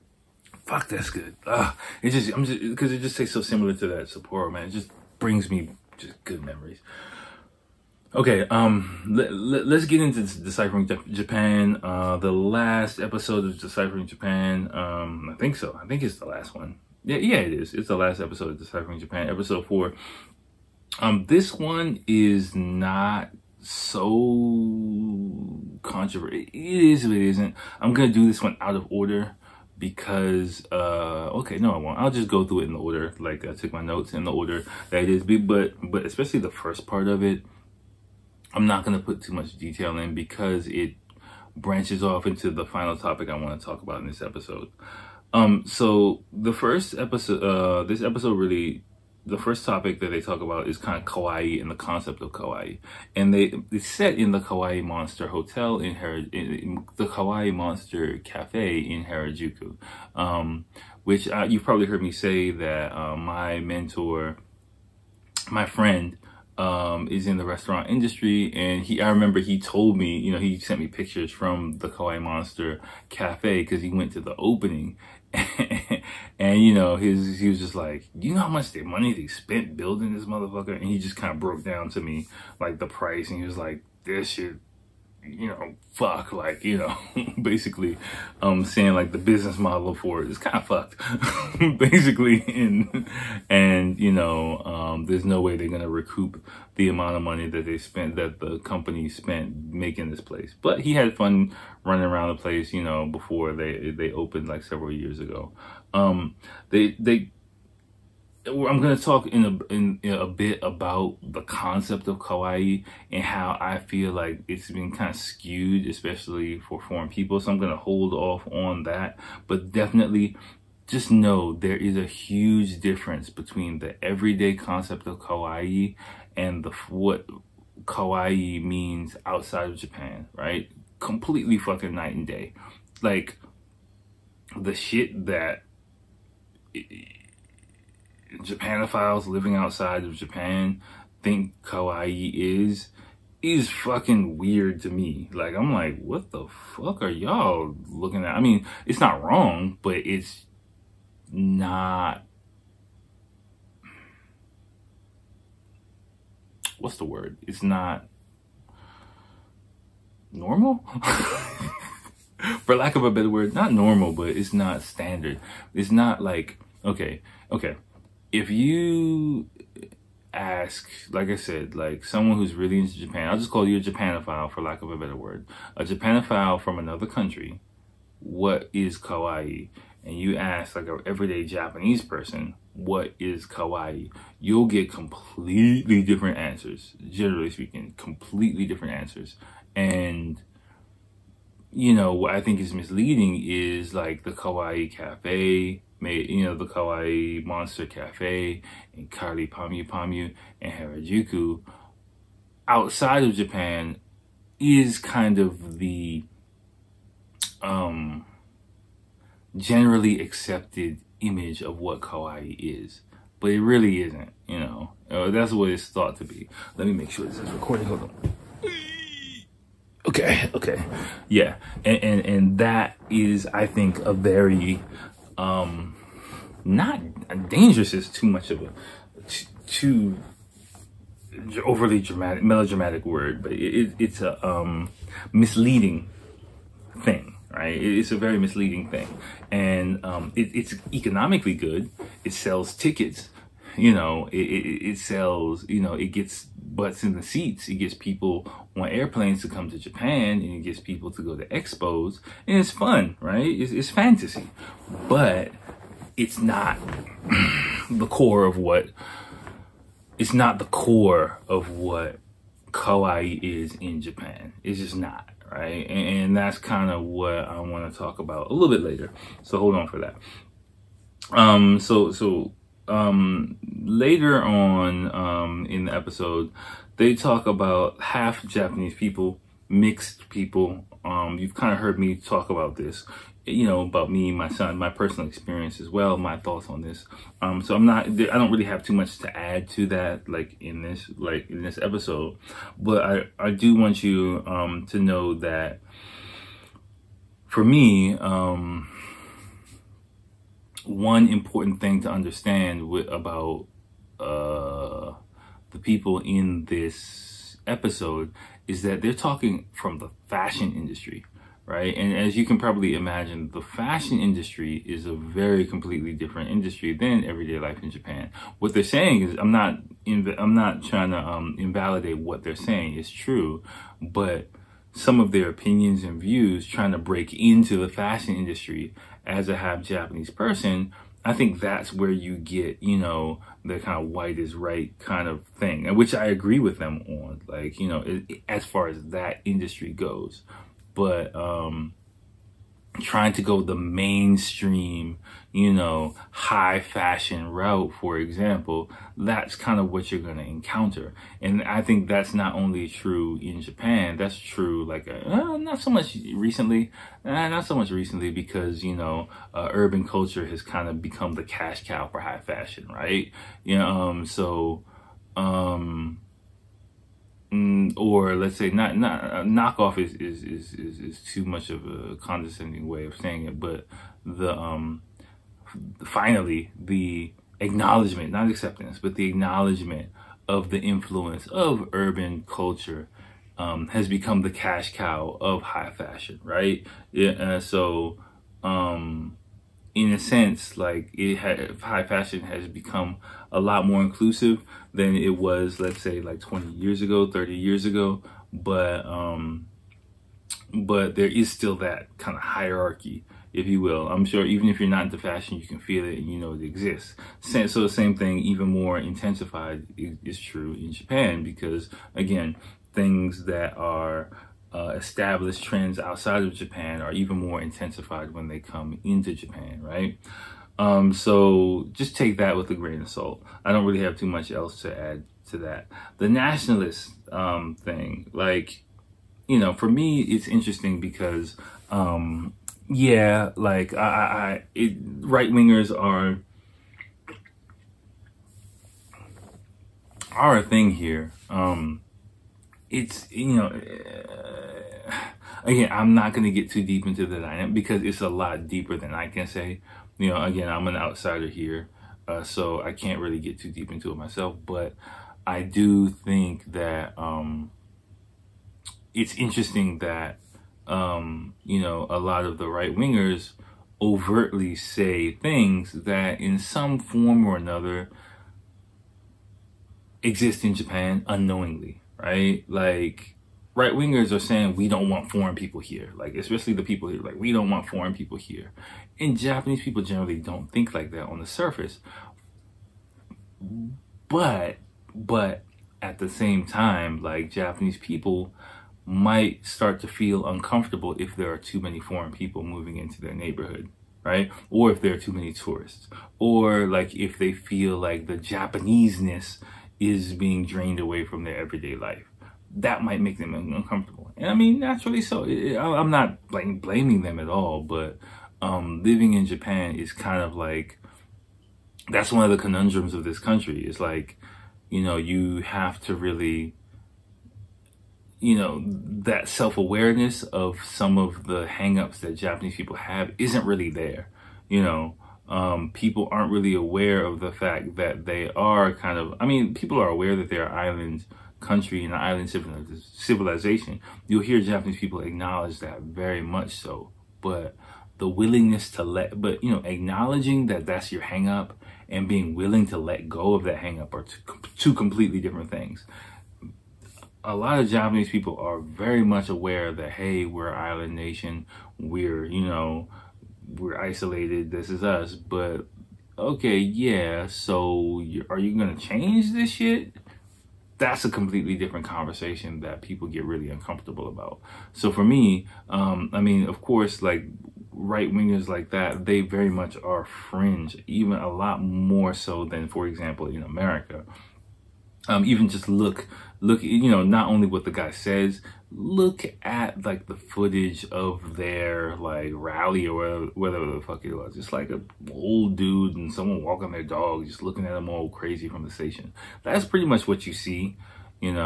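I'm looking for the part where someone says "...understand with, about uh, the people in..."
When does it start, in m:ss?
5:02.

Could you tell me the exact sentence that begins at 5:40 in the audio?
But um, trying to go the mainstream, you know, high fashion route, for example, that's kind of what you're going to encounter.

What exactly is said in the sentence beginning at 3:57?
It's a very misleading thing, and um, it, it's economically good.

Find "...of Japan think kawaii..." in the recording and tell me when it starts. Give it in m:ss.
2:20.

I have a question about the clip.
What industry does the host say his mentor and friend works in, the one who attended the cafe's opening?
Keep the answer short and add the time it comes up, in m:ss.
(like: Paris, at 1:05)
restaurant industry, at 1:07.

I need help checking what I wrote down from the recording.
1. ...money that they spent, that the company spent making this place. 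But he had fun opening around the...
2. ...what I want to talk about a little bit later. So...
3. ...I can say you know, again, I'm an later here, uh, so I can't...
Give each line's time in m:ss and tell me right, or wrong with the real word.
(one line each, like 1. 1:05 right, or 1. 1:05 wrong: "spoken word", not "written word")
1. 1:37 wrong: "running", not "opening"
2. 4:27 right
3. 7:29 wrong: "outsider", not "later".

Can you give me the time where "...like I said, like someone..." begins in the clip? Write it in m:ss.
2:51.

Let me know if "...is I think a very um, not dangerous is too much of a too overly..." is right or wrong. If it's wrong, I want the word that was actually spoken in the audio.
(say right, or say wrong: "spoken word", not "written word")
right.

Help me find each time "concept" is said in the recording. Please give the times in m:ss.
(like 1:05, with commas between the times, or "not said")
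0:51, 1:51, 2:04.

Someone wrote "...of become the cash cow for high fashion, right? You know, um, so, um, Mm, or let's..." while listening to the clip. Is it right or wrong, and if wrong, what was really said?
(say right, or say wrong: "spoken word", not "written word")
right.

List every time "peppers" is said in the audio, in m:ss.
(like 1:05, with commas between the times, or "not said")
not said.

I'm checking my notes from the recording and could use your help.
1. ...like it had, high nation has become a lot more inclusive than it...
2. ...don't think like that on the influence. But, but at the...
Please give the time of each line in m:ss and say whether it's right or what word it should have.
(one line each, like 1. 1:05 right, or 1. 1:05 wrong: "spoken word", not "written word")
1. 6:30 wrong: "fashion", not "nation"
2. 8:00 wrong: "surface", not "influence".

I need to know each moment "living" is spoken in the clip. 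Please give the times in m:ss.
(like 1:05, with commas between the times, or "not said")
2:19, 8:29.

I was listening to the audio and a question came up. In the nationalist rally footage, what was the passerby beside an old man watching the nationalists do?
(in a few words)
walking their dog.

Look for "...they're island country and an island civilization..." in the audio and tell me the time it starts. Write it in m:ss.
8:50.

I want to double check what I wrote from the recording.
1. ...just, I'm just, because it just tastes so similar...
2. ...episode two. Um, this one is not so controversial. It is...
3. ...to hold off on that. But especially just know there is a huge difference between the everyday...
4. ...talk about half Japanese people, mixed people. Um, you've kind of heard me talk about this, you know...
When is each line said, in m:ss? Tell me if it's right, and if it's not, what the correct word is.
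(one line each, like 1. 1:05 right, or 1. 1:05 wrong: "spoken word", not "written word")
1. 0:02 right
2. 0:19 wrong: "four", not "two"
3. 1:57 wrong: "definitely", not "especially"
4. 4:37 right.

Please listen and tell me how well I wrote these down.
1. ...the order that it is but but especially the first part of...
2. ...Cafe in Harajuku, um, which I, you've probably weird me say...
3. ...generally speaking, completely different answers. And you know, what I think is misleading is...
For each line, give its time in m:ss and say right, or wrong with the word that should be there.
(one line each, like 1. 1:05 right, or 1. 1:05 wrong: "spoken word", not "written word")
1. 0:34 right
2. 0:58 wrong: "heard", not "weird"
3. 3:07 right.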